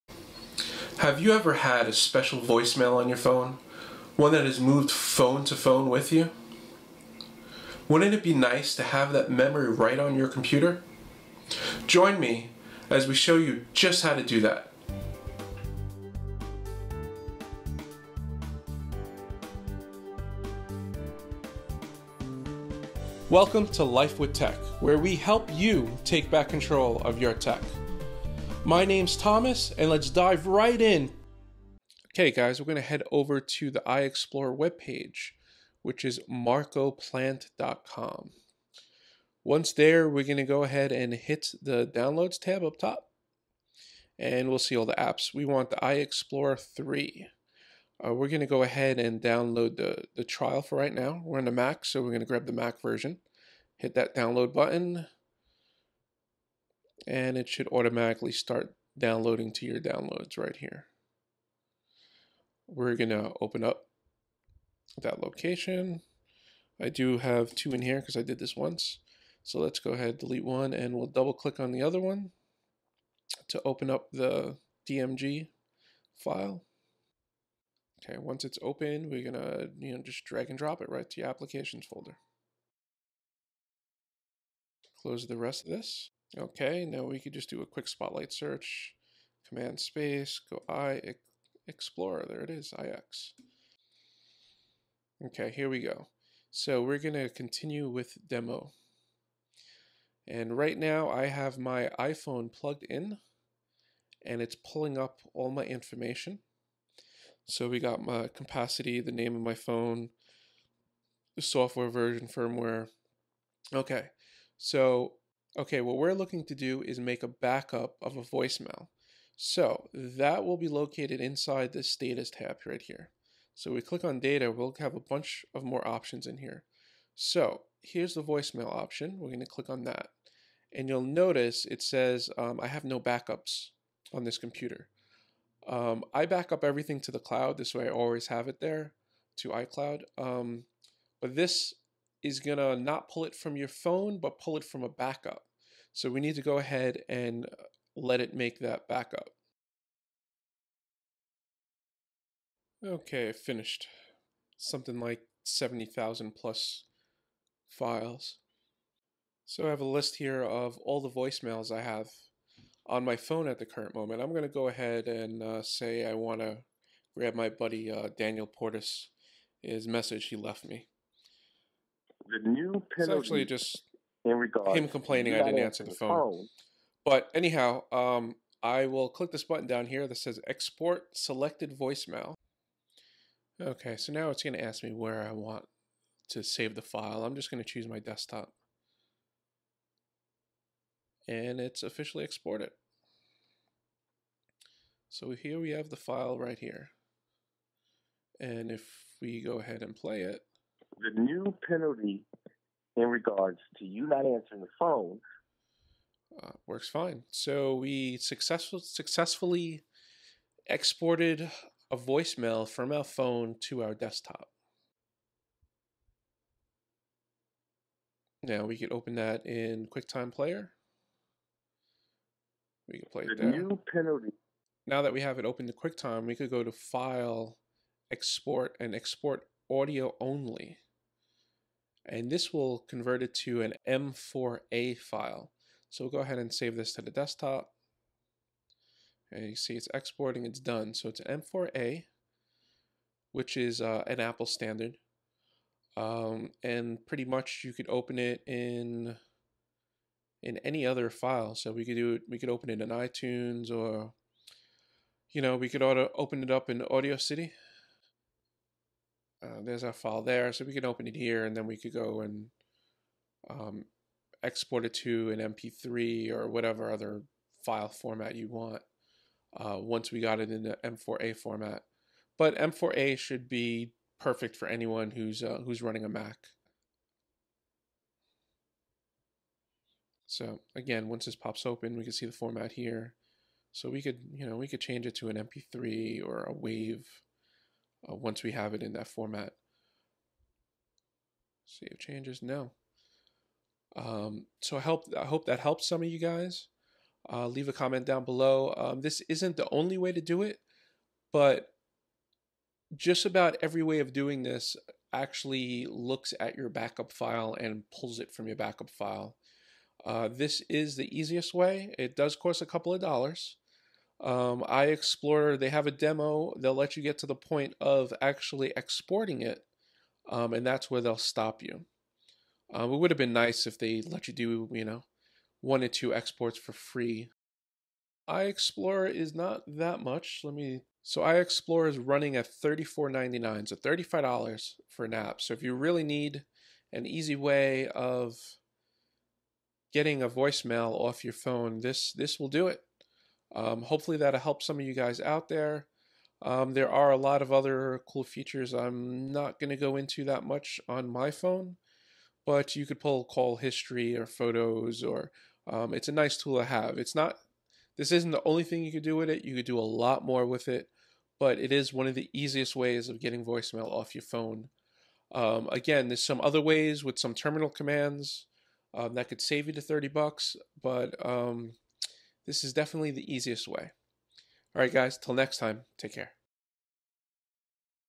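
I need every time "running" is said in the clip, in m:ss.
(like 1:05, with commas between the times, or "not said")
4:35, 5:31.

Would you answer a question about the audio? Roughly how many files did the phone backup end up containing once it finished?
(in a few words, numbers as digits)
70,000.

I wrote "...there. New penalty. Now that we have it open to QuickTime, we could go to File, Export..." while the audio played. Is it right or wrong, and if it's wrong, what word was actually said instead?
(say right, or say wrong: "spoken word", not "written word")
right.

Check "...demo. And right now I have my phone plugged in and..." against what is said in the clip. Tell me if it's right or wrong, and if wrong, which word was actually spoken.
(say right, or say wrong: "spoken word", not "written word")
wrong: "iPhone", not "phone".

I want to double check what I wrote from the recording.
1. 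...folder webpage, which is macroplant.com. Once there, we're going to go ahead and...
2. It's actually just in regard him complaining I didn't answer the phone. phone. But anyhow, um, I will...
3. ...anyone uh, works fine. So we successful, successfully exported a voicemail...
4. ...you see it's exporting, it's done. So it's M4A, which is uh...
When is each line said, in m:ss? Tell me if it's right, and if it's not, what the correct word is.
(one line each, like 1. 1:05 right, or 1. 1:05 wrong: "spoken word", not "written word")
1. 0:33 wrong: "iExplorer", not "folder"
2. 2:52 right
3. 3:24 wrong: "phone", not "anyone"
4. 3:59 right.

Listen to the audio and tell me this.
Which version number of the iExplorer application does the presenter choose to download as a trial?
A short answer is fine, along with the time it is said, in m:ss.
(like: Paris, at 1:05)
iExplorer 3, at 0:45.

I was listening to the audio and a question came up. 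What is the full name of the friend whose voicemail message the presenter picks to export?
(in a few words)
Daniel Portis.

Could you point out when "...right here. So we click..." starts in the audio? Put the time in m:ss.
2:02.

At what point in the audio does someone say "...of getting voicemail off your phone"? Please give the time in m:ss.
6:03.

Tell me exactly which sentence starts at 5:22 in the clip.
Um, it would have been nice if they let you do, you know, one or two exports for free.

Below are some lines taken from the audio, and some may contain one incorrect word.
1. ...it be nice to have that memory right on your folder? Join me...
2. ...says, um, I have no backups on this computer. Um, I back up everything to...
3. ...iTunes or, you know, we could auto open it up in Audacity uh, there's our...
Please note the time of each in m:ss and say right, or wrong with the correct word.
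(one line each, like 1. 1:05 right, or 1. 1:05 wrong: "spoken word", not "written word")
1. 0:08 wrong: "computer", not "folder"
2. 2:11 right
3. 4:12 right.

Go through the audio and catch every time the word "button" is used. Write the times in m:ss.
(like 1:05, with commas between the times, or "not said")
0:54, 2:59.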